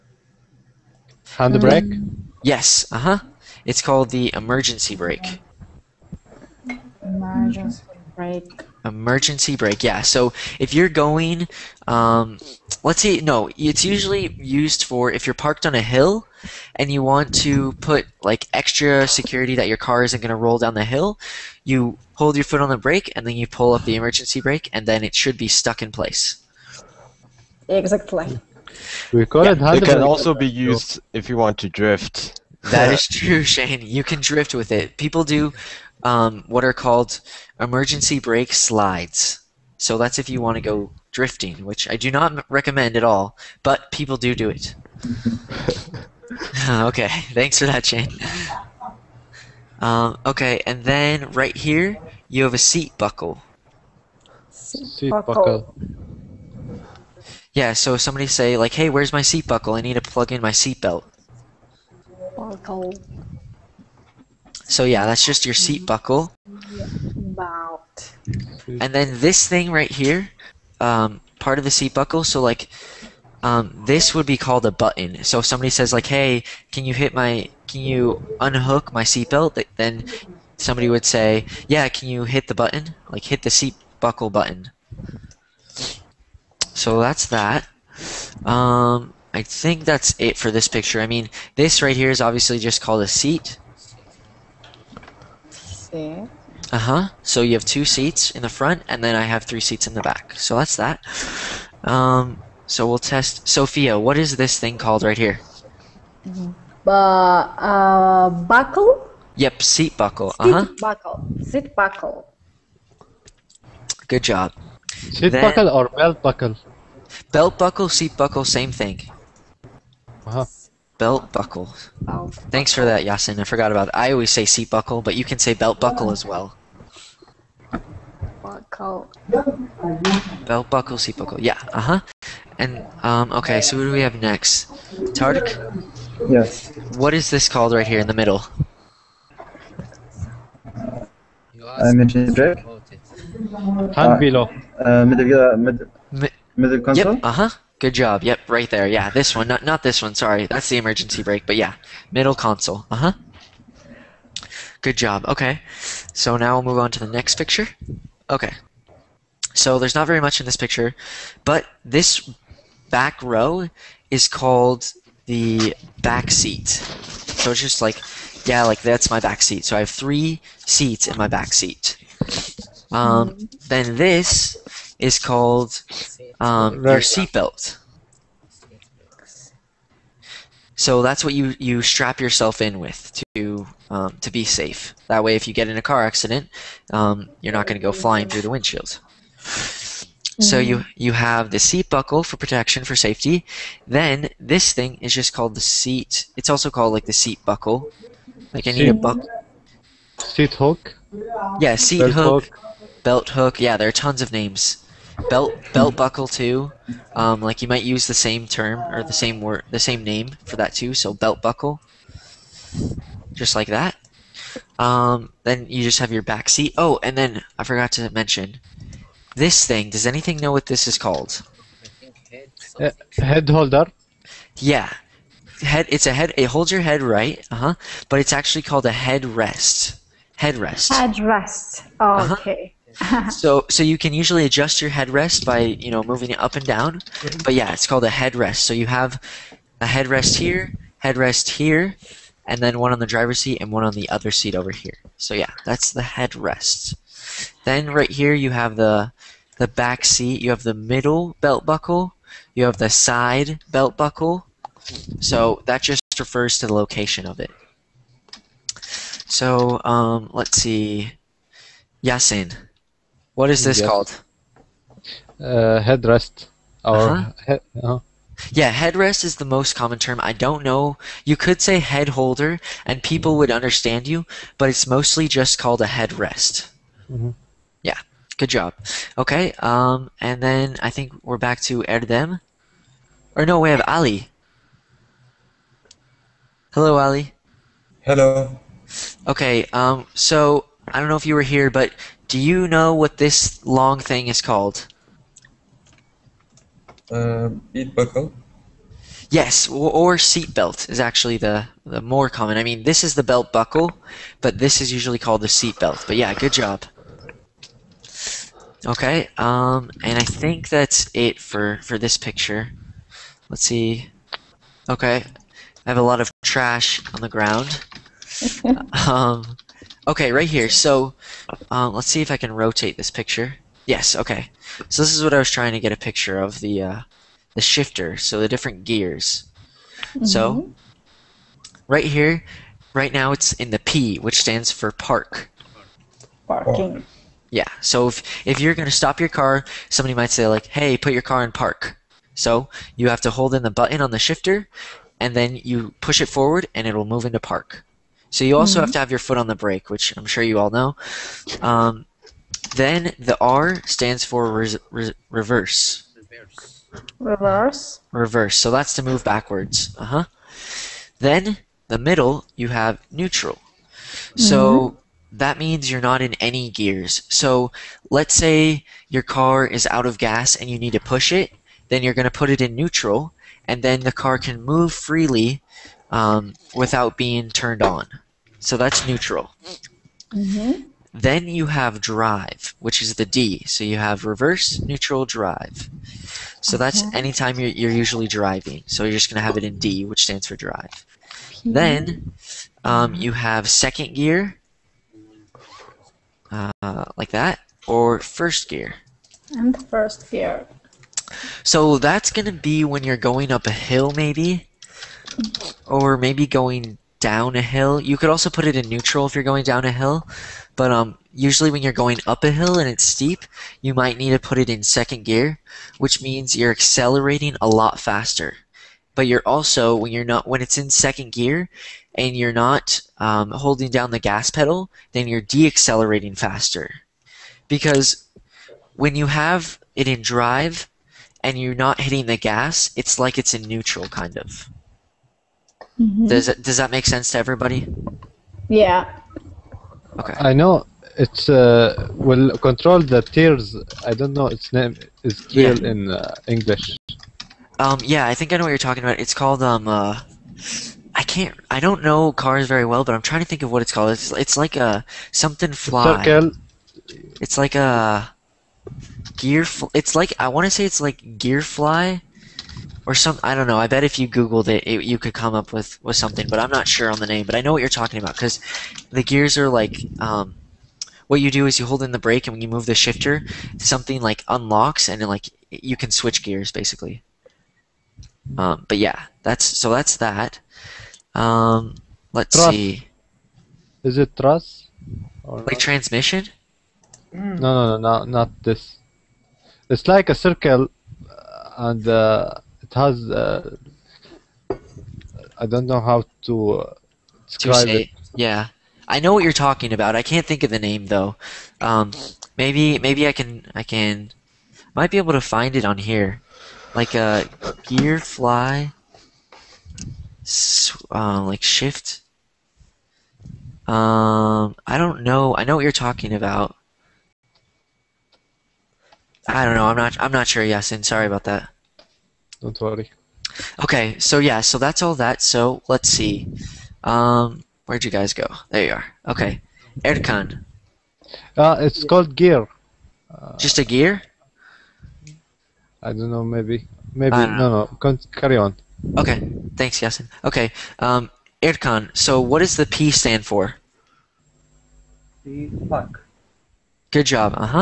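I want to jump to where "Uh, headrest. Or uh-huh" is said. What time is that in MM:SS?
04:25.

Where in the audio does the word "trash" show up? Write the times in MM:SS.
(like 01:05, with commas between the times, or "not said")
05:16.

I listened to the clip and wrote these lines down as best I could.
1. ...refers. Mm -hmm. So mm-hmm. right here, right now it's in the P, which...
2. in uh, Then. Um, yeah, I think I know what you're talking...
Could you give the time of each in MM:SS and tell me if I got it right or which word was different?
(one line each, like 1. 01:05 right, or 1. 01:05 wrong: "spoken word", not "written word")
1. 05:28 wrong: "gears", not "refers"
2. 07:25 wrong: "English", not "Then".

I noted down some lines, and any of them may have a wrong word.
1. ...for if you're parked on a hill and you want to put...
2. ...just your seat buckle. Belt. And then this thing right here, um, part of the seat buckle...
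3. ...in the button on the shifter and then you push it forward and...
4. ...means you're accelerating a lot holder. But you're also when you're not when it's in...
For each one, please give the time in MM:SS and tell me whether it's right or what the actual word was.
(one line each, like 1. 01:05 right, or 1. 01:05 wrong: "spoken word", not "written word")
1. 00:14 right
2. 01:05 right
3. 05:43 right
4. 06:56 wrong: "faster", not "holder".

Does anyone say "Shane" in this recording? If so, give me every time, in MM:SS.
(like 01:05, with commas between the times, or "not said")
00:33, 00:47.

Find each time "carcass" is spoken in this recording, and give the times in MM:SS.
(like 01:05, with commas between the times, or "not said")
not said.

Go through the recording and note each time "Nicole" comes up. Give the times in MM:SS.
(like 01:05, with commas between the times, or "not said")
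not said.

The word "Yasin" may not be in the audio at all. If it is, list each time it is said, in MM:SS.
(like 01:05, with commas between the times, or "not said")
02:03, 04:22, 08:40, 09:00.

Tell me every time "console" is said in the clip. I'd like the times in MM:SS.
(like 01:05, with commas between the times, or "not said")
02:26, 02:32.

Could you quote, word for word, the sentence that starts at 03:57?
But yeah, it's called a headrest.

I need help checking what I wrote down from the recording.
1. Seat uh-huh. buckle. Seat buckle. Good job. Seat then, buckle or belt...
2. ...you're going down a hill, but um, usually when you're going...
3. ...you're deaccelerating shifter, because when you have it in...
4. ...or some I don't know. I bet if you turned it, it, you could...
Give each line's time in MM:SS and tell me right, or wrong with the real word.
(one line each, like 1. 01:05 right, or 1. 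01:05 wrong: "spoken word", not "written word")
1. 01:50 right
2. 06:49 right
3. 07:05 wrong: "faster", not "shifter"
4. 07:43 wrong: "googled", not "turned".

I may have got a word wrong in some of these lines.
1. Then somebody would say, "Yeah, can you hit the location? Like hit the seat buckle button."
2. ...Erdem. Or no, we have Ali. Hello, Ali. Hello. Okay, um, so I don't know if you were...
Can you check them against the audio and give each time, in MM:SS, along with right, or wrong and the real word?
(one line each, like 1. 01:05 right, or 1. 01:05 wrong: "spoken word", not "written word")
1. 01:19 wrong: "button", not "location"
2. 04:41 right.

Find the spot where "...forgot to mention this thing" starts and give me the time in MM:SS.
03:37.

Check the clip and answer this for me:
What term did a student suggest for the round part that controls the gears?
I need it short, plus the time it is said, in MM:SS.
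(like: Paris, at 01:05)
transmission, at 08:05.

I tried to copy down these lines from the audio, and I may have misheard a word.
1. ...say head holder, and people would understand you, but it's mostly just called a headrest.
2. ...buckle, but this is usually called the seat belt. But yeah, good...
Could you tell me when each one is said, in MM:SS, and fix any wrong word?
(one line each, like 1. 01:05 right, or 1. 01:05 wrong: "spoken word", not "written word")
1. 04:31 right
2. 05:03 right.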